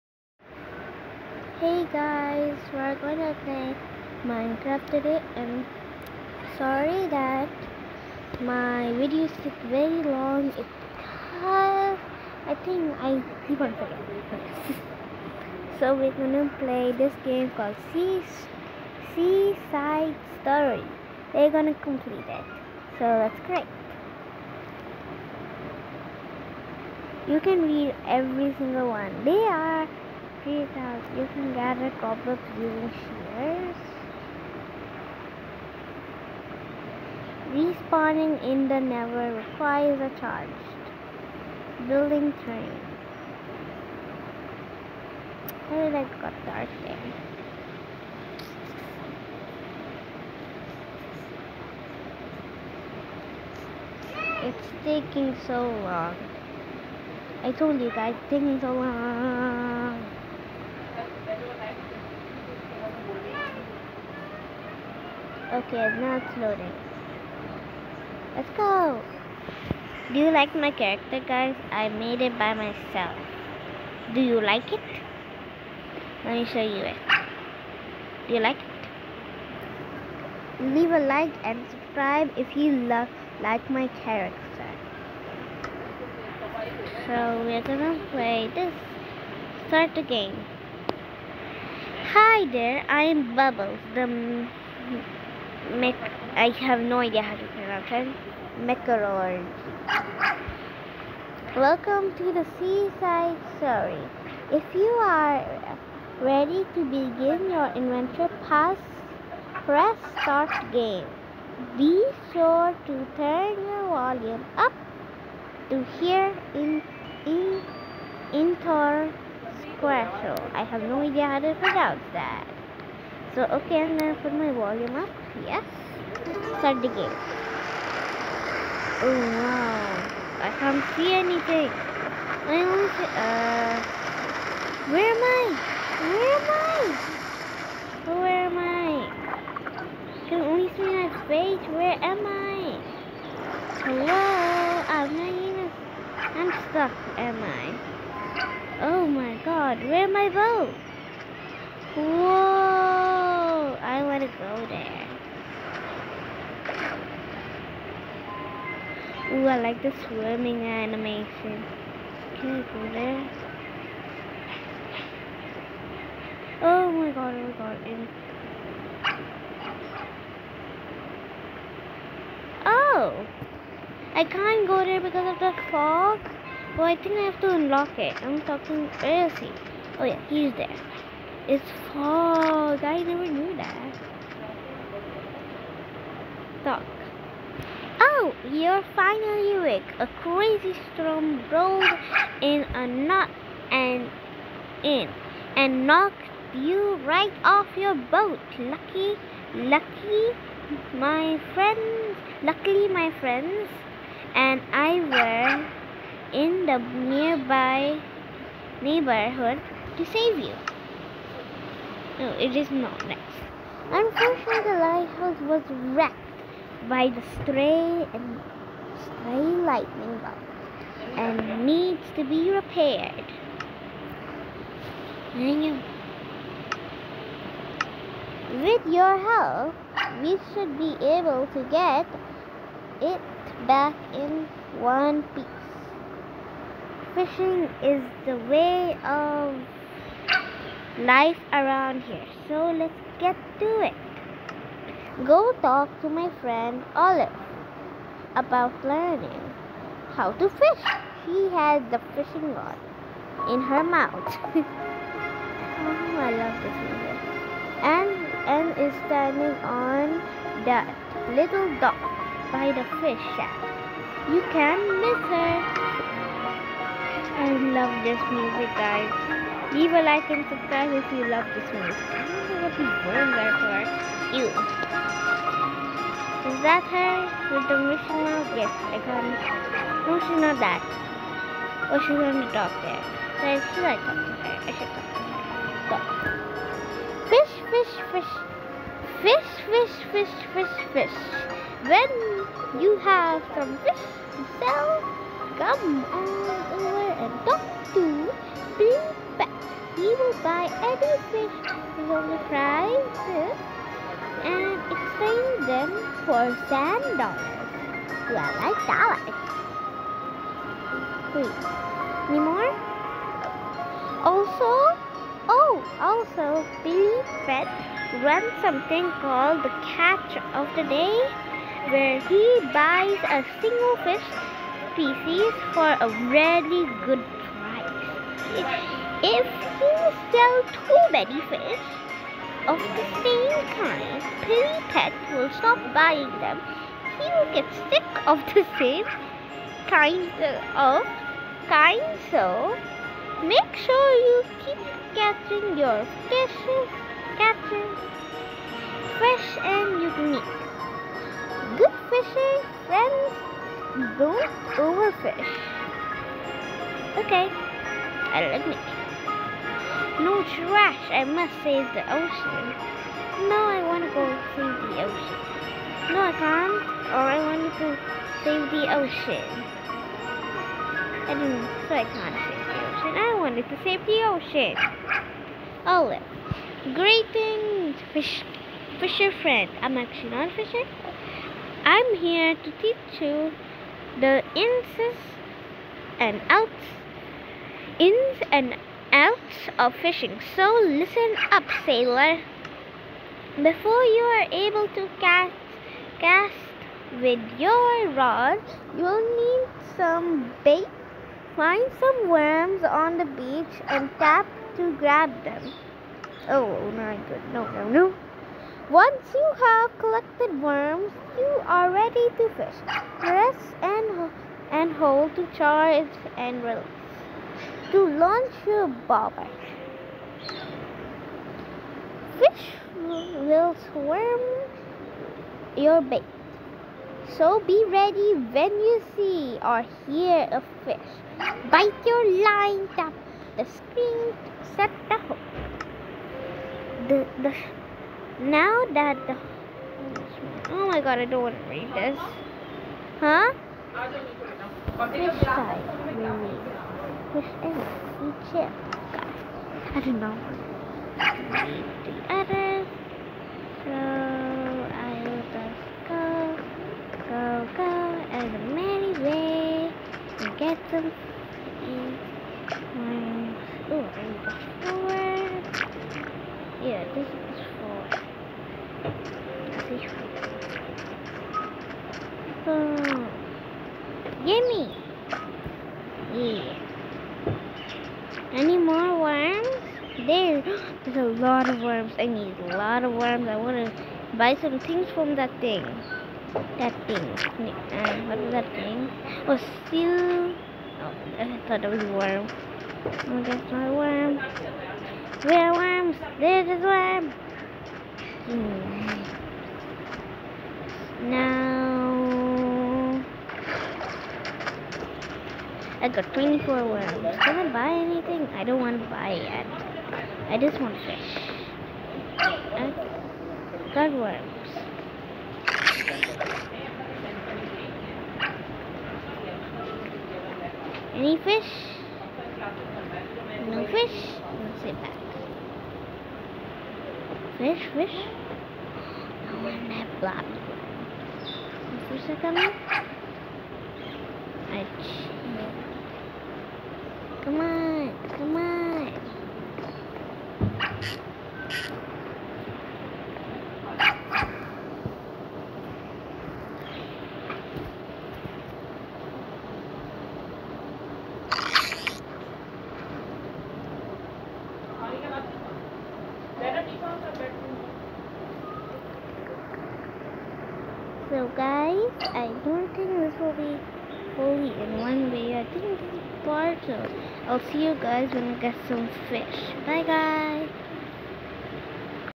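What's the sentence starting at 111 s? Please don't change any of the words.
Be sure to turn your volume up to hear in in inter squirrel.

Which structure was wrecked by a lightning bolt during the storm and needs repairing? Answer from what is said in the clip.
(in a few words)
the lighthouse.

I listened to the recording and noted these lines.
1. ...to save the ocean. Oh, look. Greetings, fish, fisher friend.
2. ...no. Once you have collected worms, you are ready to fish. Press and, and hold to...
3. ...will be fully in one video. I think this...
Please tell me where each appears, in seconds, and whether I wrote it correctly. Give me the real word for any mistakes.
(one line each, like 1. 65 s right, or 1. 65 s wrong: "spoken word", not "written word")
1. 373 s right
2. 407 s right
3. 563 s right.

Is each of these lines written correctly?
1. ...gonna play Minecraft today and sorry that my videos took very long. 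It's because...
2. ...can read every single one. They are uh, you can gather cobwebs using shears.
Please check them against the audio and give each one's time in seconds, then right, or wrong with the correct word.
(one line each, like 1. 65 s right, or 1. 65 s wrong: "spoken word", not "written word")
1. 3 s right
2. 27 s right.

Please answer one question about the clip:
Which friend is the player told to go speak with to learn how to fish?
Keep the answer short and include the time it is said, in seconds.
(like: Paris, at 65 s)
Olive, at 246 s.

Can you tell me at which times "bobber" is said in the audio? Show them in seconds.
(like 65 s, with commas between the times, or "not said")
419 s.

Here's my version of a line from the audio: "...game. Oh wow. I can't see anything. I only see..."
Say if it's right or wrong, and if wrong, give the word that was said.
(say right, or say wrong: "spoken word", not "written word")
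right.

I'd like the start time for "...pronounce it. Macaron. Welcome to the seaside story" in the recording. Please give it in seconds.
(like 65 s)
97 s.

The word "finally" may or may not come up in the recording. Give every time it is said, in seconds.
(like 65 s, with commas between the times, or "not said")
188 s.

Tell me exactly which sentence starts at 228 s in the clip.
With your help, we should be able to get it back in one piece.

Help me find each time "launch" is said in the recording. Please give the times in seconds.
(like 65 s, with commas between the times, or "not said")
418 s.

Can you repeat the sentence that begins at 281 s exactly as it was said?
Oh, she going to talk there.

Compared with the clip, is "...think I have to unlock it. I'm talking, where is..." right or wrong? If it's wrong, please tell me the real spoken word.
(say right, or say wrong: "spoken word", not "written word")
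right.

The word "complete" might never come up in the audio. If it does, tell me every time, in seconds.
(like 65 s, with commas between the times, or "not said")
21 s.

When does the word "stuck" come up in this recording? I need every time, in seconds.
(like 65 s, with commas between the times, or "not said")
146 s, 186 s.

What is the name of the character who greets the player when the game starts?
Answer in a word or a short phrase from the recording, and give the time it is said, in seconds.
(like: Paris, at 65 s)
Bubbles, at 93 s.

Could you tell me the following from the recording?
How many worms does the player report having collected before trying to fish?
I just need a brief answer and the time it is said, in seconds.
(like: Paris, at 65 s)
24, at 506 s.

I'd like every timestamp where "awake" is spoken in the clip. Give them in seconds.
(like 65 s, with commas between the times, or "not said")
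189 s.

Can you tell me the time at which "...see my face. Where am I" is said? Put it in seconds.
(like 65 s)
140 s.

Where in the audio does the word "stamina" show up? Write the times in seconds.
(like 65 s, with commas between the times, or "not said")
not said.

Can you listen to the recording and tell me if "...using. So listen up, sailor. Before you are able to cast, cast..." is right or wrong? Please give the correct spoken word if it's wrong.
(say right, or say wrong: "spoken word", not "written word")
wrong: "fishing", not "using".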